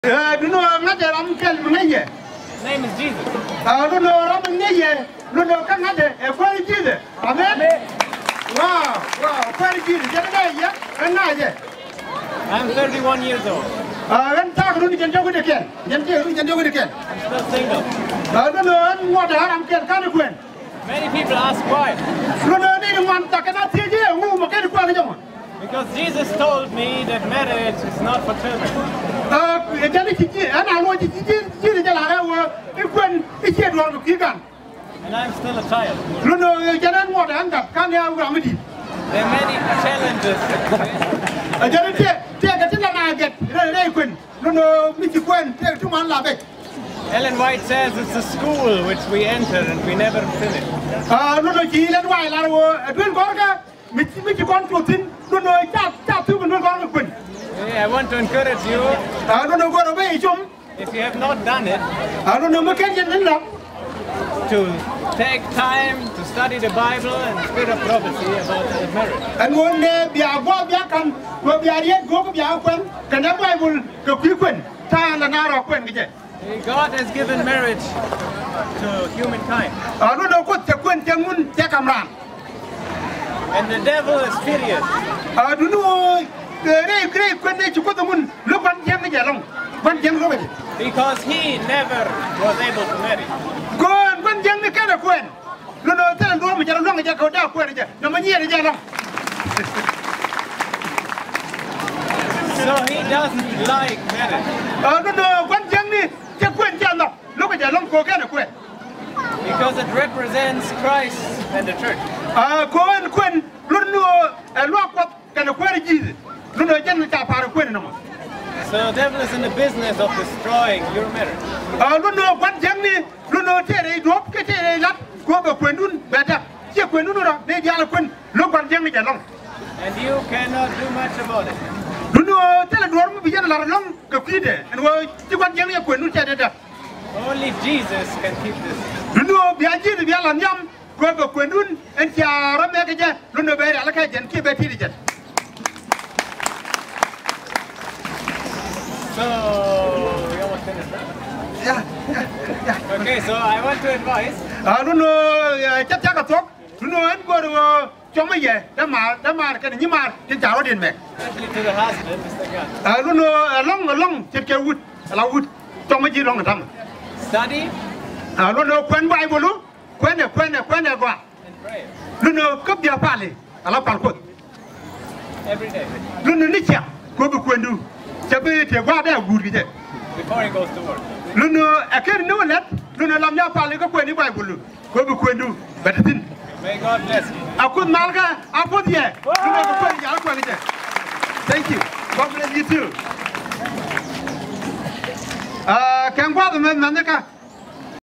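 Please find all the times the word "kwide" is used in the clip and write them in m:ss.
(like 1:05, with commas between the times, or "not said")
2:14.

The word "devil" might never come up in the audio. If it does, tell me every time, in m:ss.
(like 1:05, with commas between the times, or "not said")
1:23, 1:58.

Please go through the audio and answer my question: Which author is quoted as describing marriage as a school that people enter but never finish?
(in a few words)
Ellen White.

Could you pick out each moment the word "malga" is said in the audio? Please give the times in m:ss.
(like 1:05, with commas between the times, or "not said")
3:07.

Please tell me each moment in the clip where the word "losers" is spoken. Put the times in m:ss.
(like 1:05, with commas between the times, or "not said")
not said.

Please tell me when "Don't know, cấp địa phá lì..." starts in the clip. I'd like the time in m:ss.
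2:52.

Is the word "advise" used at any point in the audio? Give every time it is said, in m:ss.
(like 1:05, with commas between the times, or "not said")
2:33.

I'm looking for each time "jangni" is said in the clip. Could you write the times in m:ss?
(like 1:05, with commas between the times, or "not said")
2:02, 2:08, 2:15.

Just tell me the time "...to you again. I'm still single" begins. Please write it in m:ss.
0:14.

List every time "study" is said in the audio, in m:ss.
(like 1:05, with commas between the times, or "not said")
1:06, 2:47.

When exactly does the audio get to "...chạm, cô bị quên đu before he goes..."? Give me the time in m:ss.
2:56.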